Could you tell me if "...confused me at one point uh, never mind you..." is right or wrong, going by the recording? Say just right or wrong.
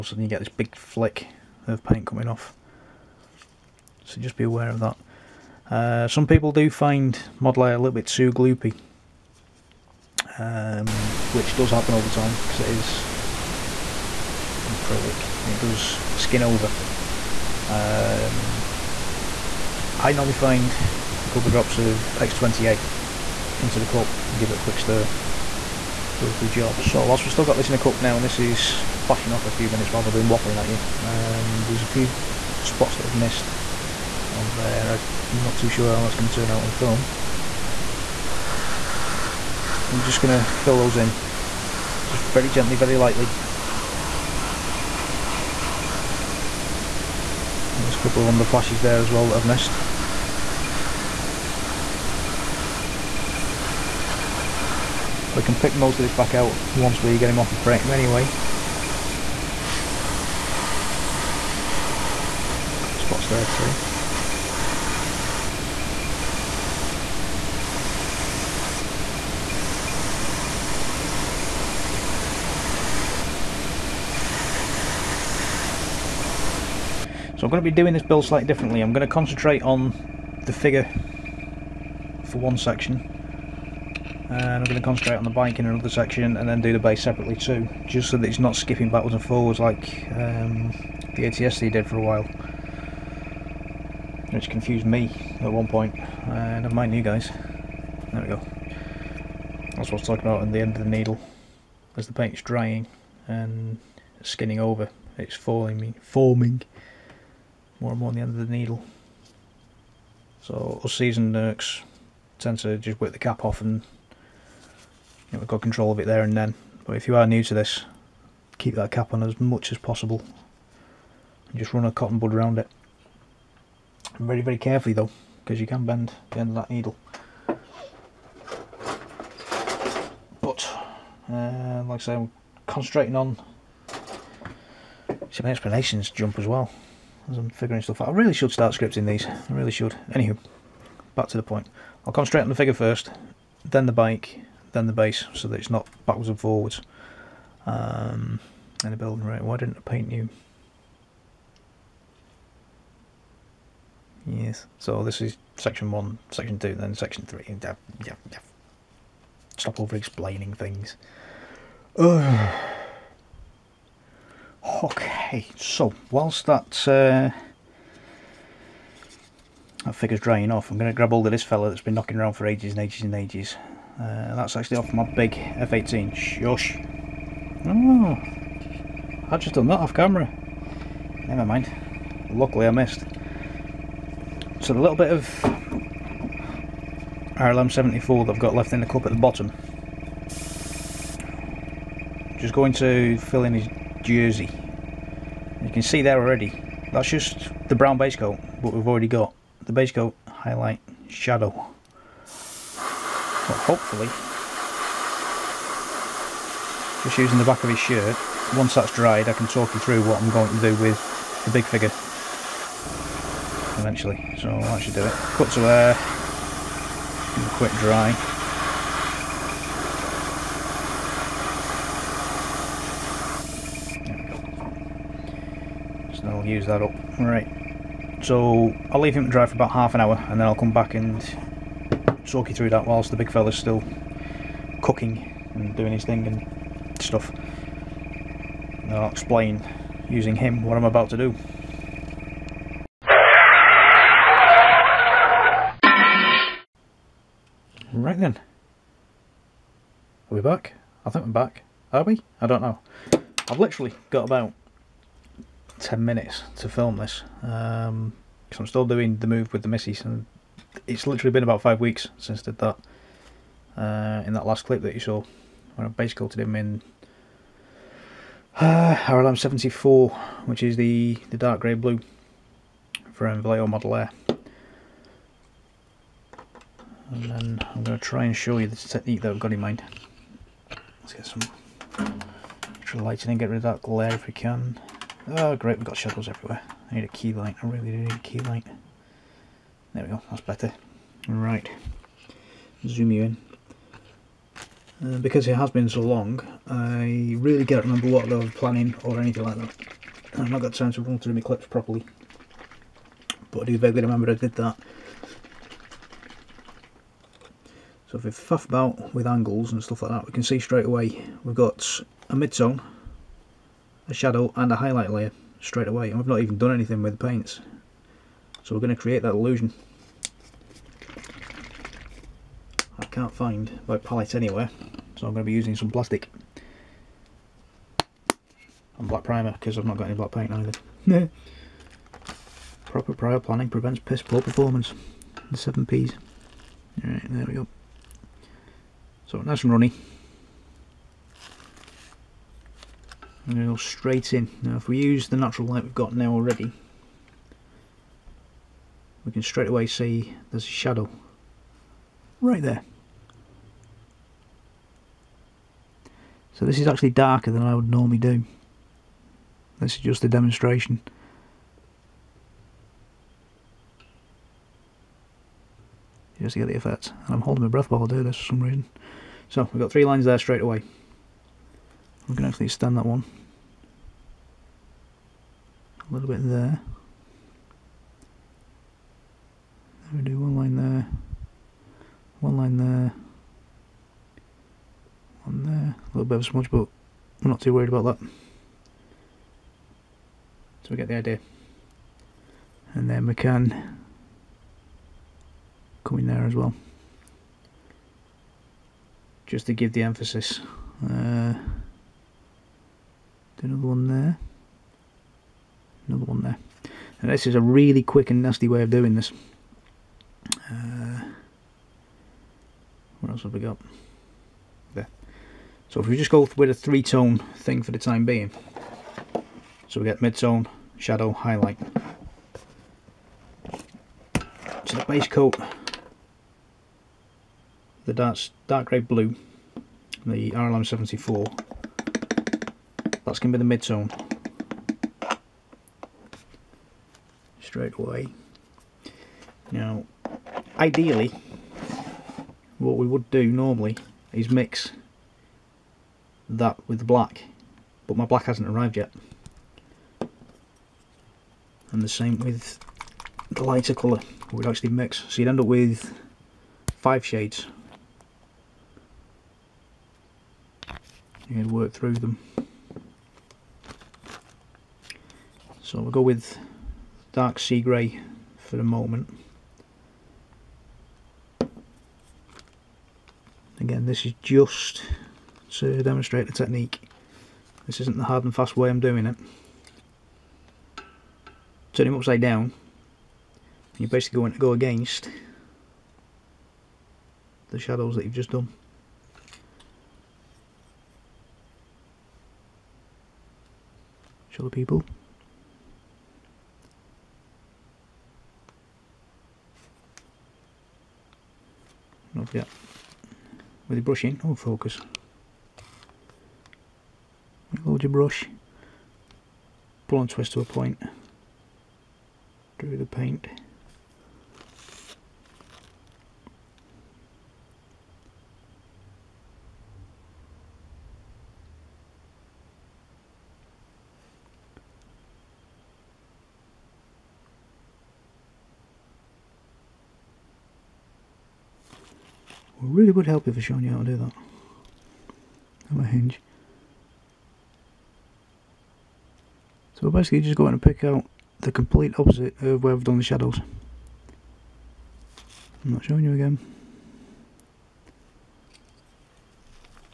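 right.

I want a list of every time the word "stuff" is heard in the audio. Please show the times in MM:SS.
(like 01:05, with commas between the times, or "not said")
02:17, 03:57, 05:09.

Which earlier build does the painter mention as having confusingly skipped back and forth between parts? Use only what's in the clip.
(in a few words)
ATST.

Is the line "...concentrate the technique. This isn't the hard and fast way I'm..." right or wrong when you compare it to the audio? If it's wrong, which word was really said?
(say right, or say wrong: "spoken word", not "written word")
wrong: "demonstrate", not "concentrate".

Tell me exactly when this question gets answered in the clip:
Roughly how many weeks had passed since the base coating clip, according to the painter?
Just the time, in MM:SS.
04:21.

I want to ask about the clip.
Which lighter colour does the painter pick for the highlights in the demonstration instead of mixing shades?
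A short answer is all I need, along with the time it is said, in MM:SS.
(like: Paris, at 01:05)
Dark sea grey, at 07:47.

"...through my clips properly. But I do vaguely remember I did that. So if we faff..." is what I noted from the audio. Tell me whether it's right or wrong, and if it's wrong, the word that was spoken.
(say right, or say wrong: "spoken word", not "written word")
right.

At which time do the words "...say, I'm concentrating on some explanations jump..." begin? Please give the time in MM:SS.
02:12.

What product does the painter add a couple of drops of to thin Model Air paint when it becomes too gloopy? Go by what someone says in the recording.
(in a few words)
X20A.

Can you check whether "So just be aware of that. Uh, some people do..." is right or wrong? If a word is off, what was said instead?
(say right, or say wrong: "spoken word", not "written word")
right.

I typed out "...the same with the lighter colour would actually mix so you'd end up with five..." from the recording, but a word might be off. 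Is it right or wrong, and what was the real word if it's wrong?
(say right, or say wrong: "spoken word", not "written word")
right.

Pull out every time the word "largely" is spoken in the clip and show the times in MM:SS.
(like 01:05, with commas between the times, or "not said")
not said.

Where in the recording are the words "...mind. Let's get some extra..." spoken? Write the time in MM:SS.
04:39.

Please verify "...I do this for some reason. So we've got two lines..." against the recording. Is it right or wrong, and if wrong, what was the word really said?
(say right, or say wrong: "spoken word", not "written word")
wrong: "three", not "two".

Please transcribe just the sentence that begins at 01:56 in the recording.
But if you are new to this, keep that cap on as much as possible.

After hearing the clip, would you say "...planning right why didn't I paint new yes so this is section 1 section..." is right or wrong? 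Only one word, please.
wrong.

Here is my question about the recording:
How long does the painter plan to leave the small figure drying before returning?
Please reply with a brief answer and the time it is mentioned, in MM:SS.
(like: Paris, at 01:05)
About half an hour, at 03:49.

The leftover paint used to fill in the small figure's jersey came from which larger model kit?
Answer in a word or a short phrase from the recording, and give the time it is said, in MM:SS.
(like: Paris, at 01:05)
F18, at 02:55.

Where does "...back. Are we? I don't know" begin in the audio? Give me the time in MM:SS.
04:11.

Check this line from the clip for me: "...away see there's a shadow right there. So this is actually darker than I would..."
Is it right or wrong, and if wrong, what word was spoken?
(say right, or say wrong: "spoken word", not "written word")
right.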